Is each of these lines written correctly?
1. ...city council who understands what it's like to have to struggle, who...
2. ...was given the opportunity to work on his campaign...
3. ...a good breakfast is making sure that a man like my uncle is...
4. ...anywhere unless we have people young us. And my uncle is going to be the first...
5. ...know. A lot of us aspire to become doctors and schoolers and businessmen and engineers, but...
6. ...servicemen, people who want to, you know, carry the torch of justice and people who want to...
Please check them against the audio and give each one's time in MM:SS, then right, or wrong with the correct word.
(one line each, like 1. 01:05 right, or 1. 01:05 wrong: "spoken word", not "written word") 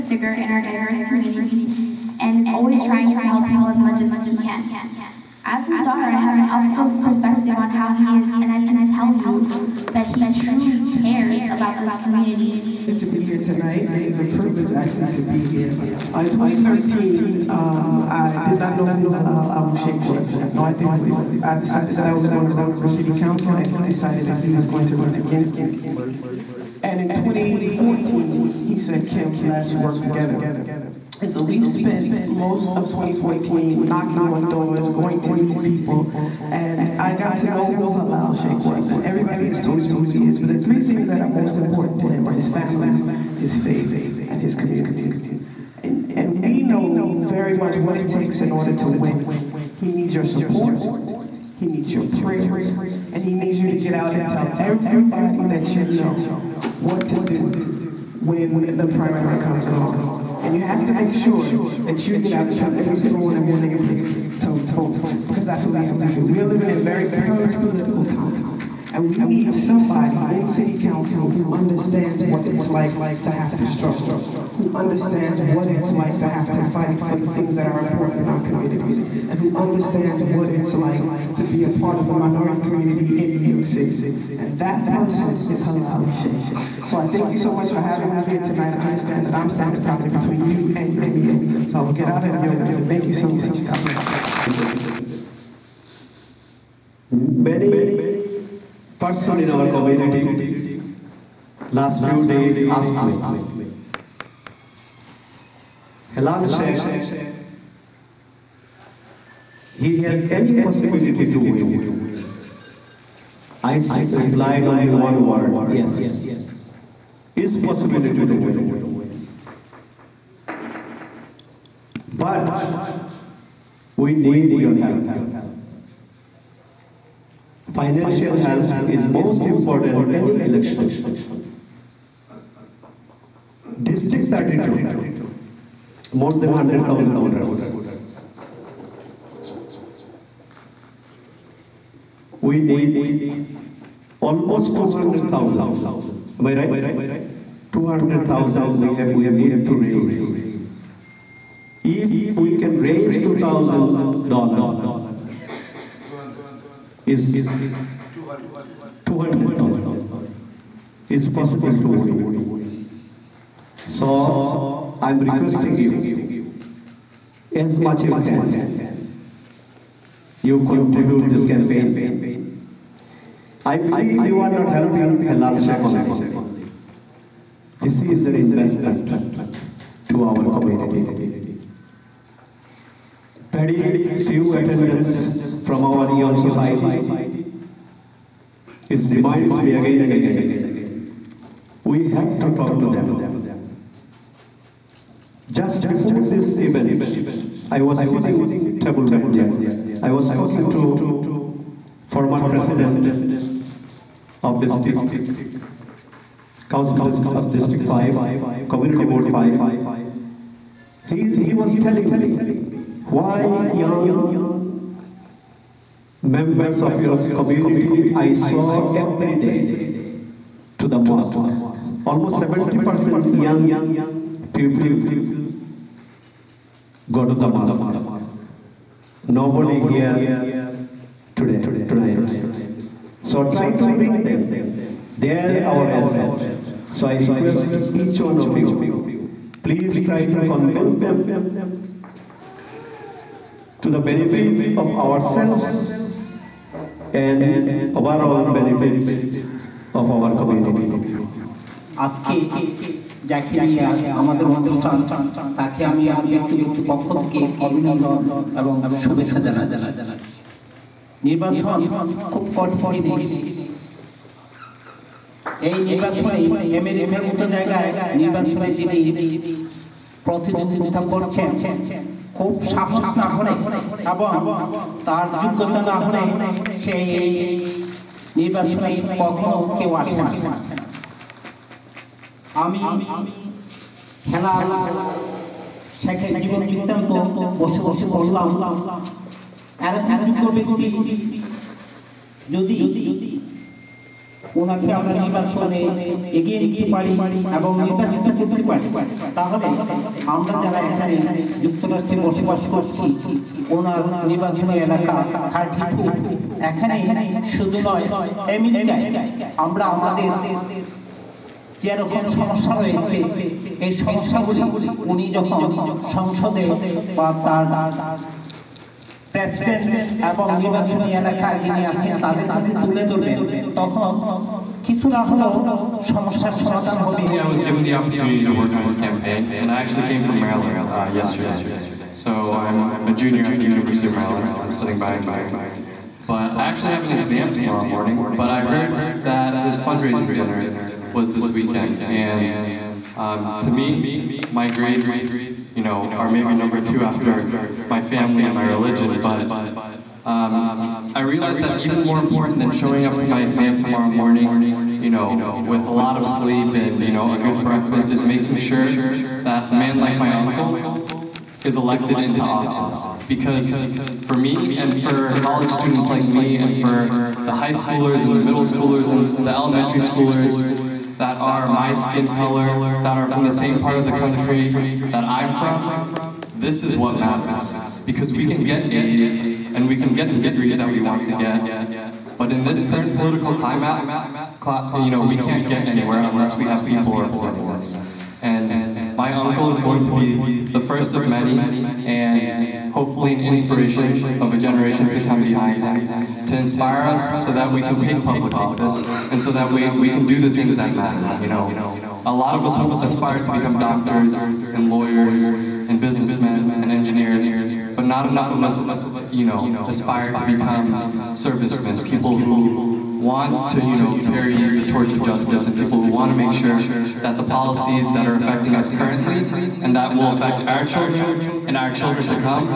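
1. 01:10 right
2. 05:27 right
3. 05:57 right
4. 06:25 wrong: "representing", not "young"
5. 06:41 wrong: "lawyers", not "schoolers"
6. 06:51 right.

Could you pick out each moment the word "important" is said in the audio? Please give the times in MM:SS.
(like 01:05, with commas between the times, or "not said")
00:41, 01:17, 02:09, 05:52.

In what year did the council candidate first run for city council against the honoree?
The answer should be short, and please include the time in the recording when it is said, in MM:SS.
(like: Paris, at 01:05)
2013, at 00:16.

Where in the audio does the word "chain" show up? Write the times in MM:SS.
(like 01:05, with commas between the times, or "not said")
not said.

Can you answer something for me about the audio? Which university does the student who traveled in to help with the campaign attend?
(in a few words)
University of Maryland.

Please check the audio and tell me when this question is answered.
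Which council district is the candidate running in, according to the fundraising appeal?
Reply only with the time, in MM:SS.
02:13.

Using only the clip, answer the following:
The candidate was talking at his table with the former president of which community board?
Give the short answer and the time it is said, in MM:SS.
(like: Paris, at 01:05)
Community Board 5, at 03:28.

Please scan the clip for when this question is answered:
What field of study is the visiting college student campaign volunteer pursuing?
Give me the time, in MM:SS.
05:35.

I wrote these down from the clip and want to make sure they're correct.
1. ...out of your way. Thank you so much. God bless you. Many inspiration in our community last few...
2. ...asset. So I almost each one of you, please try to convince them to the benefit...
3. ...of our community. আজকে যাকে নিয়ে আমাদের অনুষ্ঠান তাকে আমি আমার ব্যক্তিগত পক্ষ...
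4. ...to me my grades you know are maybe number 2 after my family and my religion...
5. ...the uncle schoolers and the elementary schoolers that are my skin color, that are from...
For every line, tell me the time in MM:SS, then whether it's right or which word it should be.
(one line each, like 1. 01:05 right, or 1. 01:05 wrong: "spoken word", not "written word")
1. 01:32 wrong: "person", not "inspiration"
2. 03:55 wrong: "request", not "almost"
3. 04:09 right
4. 05:43 right
5. 06:08 wrong: "middle", not "uncle".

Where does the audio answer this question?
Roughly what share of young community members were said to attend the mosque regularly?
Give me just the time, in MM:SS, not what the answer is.
03:42.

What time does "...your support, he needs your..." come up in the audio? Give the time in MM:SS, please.
00:50.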